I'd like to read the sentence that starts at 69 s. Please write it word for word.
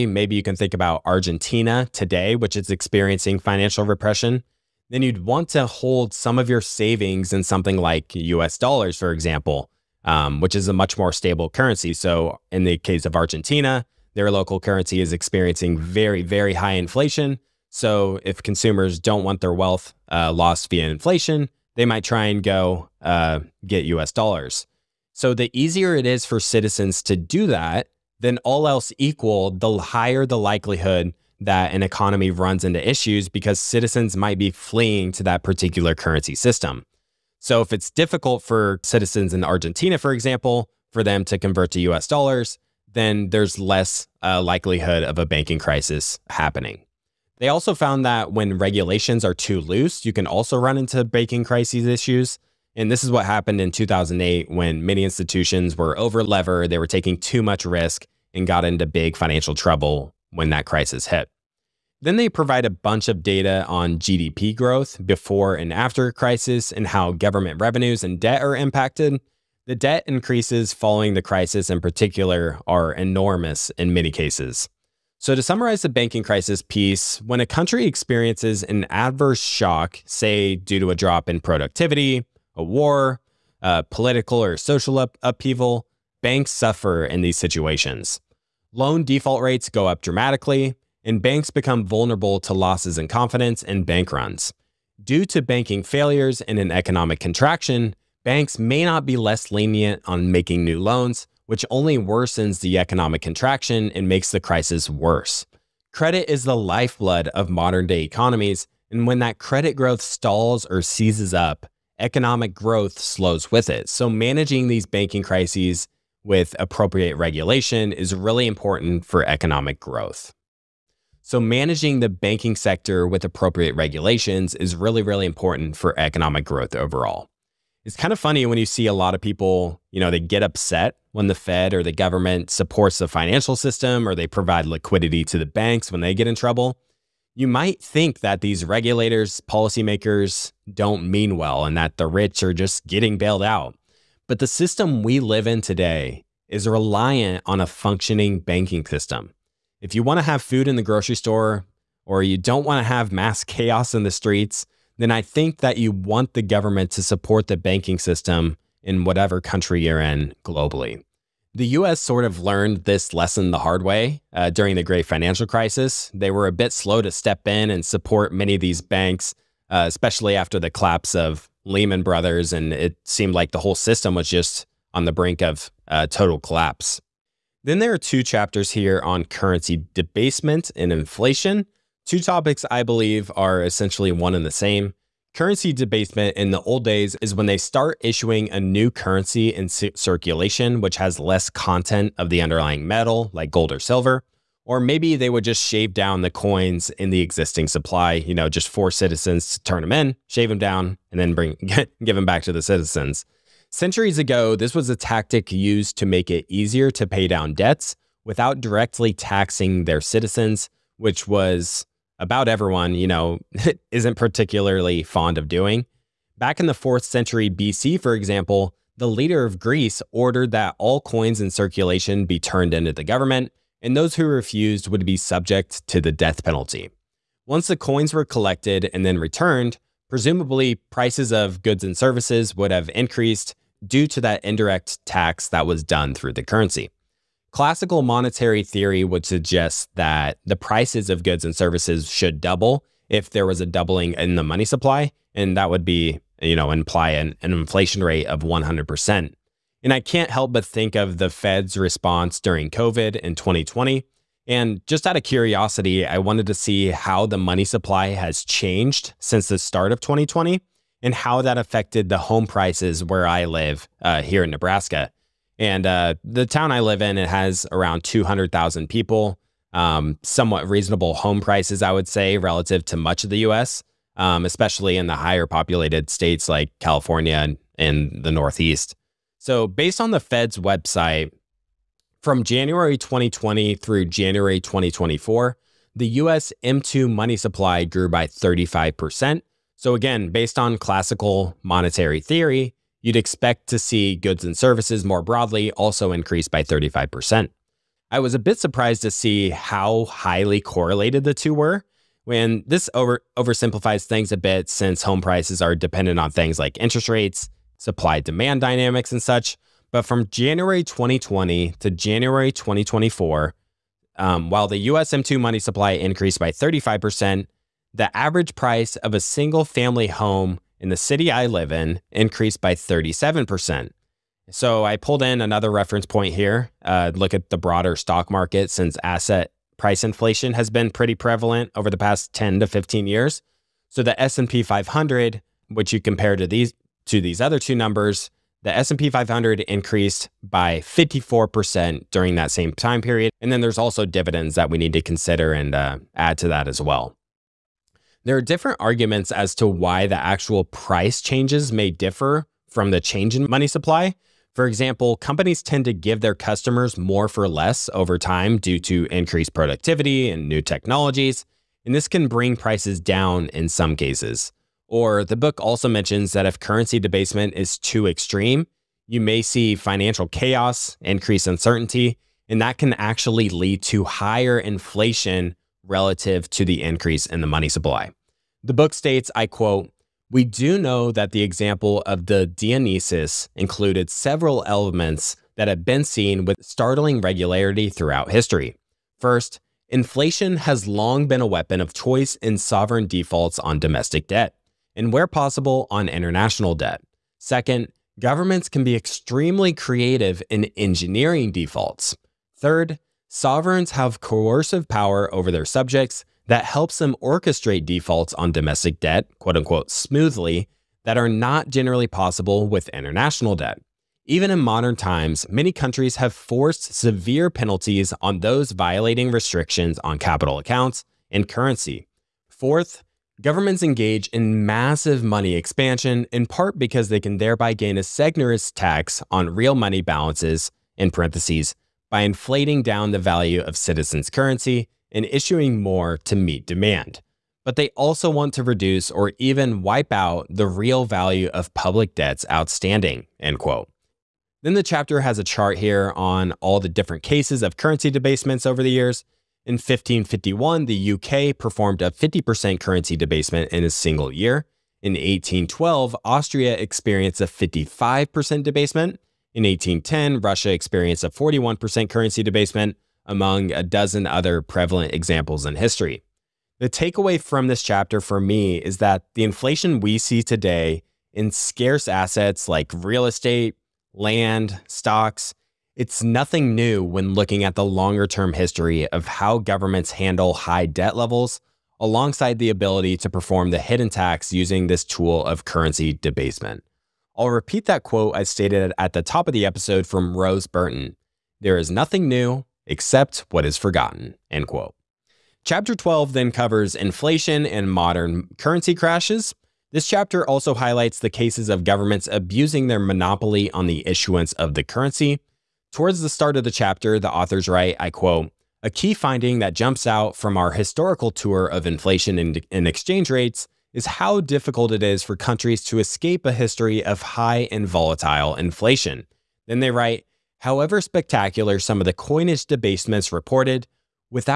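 The debt increases following the crisis in particular are enormous in many cases.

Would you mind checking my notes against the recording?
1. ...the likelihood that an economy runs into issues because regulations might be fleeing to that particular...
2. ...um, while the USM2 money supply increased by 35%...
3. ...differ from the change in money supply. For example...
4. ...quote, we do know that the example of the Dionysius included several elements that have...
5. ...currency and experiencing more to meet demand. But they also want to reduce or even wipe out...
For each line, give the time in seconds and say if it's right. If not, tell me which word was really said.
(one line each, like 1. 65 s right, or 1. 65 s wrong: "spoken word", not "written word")
1. 30 s wrong: "citizens", not "regulations"
2. 314 s right
3. 351 s right
4. 379 s right
5. 434 s wrong: "issuing", not "experiencing".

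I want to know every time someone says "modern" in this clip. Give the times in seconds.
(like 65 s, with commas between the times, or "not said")
107 s, 414 s, 497 s.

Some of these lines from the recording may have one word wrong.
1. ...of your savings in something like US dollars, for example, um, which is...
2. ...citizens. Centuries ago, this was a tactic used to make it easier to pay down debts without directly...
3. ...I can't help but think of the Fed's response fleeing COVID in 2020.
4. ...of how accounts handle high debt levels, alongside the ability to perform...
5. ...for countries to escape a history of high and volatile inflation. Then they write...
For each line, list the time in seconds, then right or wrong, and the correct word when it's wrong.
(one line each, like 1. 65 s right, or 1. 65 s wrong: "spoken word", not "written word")
1. 6 s right
2. 202 s right
3. 249 s wrong: "during", not "fleeing"
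4. 479 s wrong: "governments", not "accounts"
5. 515 s right.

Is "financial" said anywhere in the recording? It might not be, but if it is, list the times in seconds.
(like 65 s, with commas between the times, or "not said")
3 s, 59 s, 133 s, 165 s, 369 s.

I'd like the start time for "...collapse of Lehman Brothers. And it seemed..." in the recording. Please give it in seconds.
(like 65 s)
170 s.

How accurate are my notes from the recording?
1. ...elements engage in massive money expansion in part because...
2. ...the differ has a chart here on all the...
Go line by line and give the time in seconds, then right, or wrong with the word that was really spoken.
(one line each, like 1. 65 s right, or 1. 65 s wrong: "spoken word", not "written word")
1. 423 s wrong: "governments", not "elements"
2. 444 s wrong: "chapter", not "differ".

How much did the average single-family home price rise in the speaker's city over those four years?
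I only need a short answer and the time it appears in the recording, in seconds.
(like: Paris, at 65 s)
37%, at 322 s.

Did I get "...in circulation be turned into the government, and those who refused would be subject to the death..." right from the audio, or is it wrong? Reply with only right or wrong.
right.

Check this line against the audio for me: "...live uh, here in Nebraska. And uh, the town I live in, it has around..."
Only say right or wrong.
right.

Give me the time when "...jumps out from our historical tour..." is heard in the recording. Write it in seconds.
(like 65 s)
509 s.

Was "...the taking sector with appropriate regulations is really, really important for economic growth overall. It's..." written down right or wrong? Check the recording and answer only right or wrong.
wrong.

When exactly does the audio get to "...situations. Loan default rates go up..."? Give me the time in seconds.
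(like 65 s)
87 s.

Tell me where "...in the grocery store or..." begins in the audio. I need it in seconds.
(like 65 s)
150 s.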